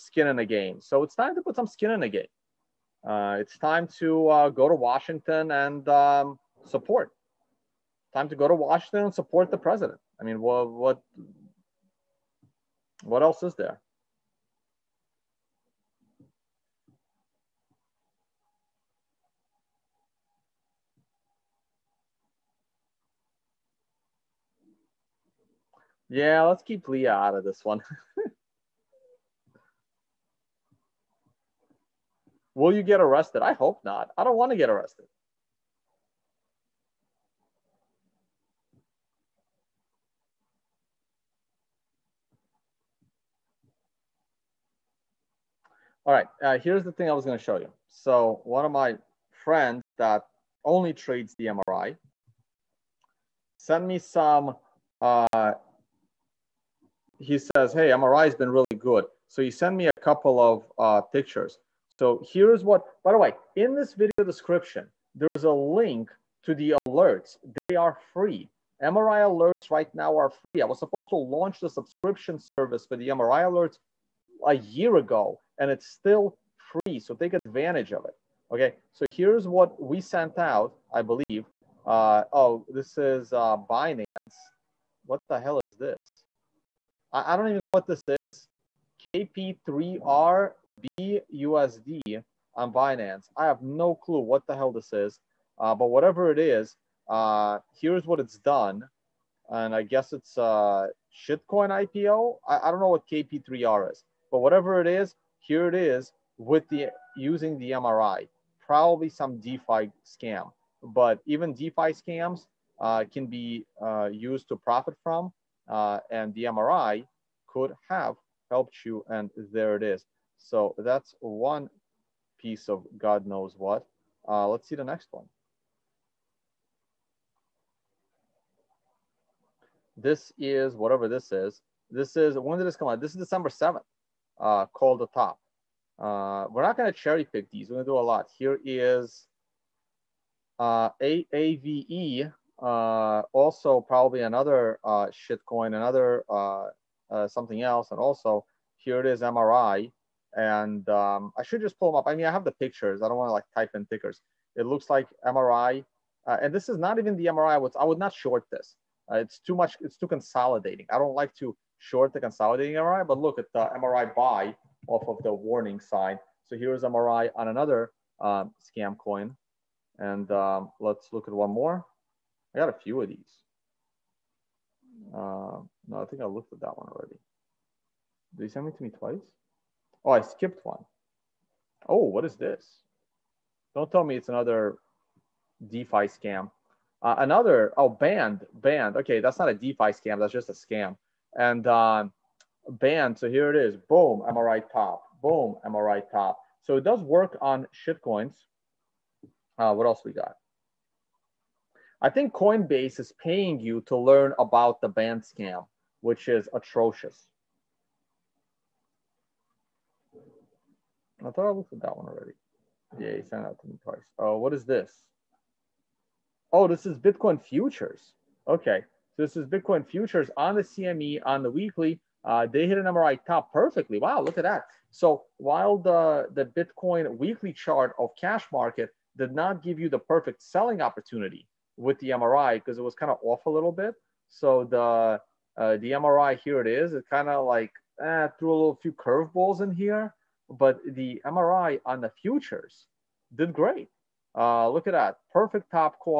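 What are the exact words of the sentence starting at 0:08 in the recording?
Time to go to Washington and support the president.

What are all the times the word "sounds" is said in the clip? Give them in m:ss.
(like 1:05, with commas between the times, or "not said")
not said.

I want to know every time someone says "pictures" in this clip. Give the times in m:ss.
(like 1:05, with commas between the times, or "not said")
1:01, 2:32.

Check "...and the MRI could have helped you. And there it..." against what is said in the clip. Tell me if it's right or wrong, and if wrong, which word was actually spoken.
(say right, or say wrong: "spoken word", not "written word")
right.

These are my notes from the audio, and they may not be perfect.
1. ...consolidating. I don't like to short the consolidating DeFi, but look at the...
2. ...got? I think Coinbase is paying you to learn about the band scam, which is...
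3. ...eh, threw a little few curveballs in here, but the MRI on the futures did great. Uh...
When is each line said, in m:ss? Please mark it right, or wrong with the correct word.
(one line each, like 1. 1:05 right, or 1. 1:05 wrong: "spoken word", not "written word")
1. 2:40 wrong: "MRI", not "DeFi"
2. 3:20 right
3. 3:58 right.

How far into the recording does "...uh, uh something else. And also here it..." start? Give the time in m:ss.
2:26.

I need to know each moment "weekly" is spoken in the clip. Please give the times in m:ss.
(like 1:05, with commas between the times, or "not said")
3:41, 3:47.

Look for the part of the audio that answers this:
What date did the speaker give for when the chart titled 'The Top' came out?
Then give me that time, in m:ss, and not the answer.
2:13.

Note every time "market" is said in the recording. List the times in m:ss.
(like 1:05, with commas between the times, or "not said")
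3:48.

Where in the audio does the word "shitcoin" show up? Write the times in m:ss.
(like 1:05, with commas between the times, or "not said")
1:41, 2:25, 3:17.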